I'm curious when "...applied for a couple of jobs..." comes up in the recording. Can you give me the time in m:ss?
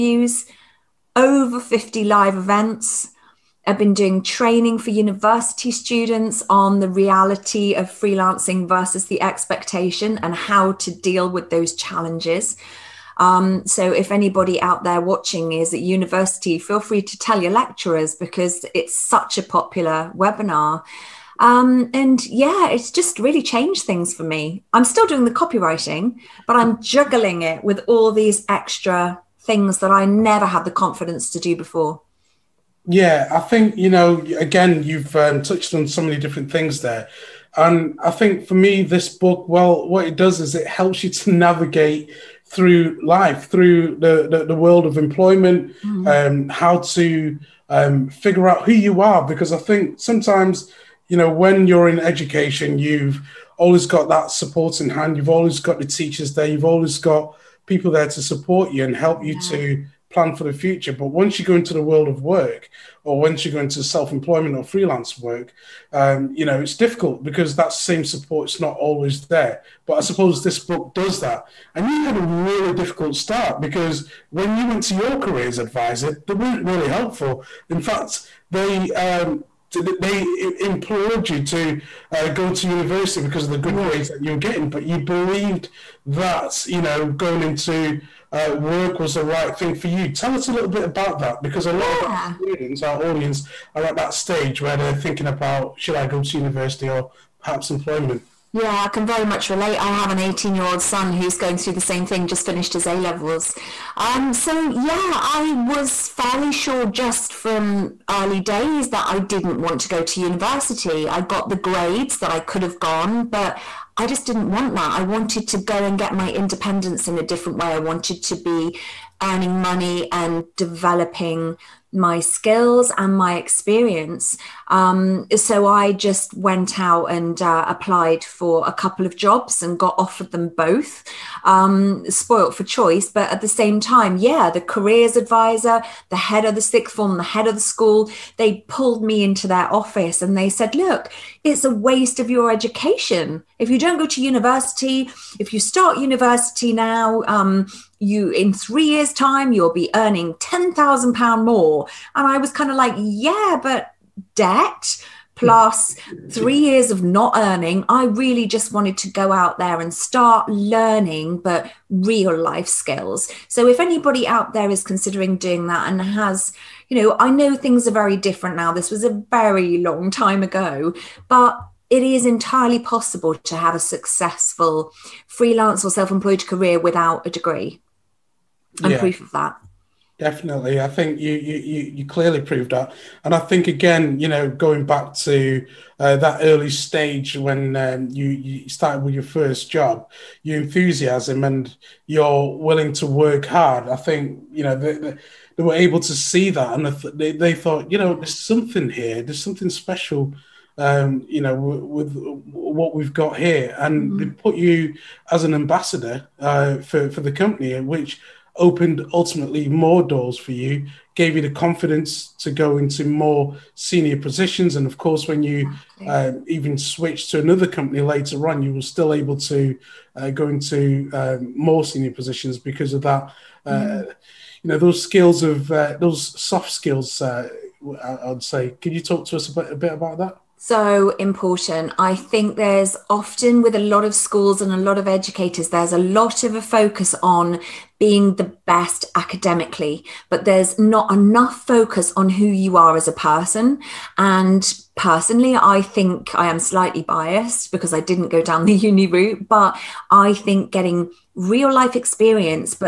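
2:07.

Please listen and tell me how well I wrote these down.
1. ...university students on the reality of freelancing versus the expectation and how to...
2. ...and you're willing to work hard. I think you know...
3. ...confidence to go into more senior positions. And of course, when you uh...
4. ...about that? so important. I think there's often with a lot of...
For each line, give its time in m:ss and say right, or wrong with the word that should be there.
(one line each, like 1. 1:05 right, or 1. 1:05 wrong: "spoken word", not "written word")
1. 0:04 right
2. 3:11 right
3. 3:31 right
4. 3:49 right.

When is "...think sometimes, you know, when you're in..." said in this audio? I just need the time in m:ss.
0:49.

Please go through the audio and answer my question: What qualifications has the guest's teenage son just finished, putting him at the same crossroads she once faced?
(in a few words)
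A levels.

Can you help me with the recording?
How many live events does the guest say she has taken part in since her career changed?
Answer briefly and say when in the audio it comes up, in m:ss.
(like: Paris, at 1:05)
over 50, at 0:01.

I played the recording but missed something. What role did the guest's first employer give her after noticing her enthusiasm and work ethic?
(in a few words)
ambassador.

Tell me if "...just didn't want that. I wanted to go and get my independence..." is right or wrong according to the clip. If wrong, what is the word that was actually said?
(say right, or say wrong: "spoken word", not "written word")
right.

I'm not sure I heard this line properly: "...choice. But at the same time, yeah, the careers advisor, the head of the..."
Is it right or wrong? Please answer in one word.
right.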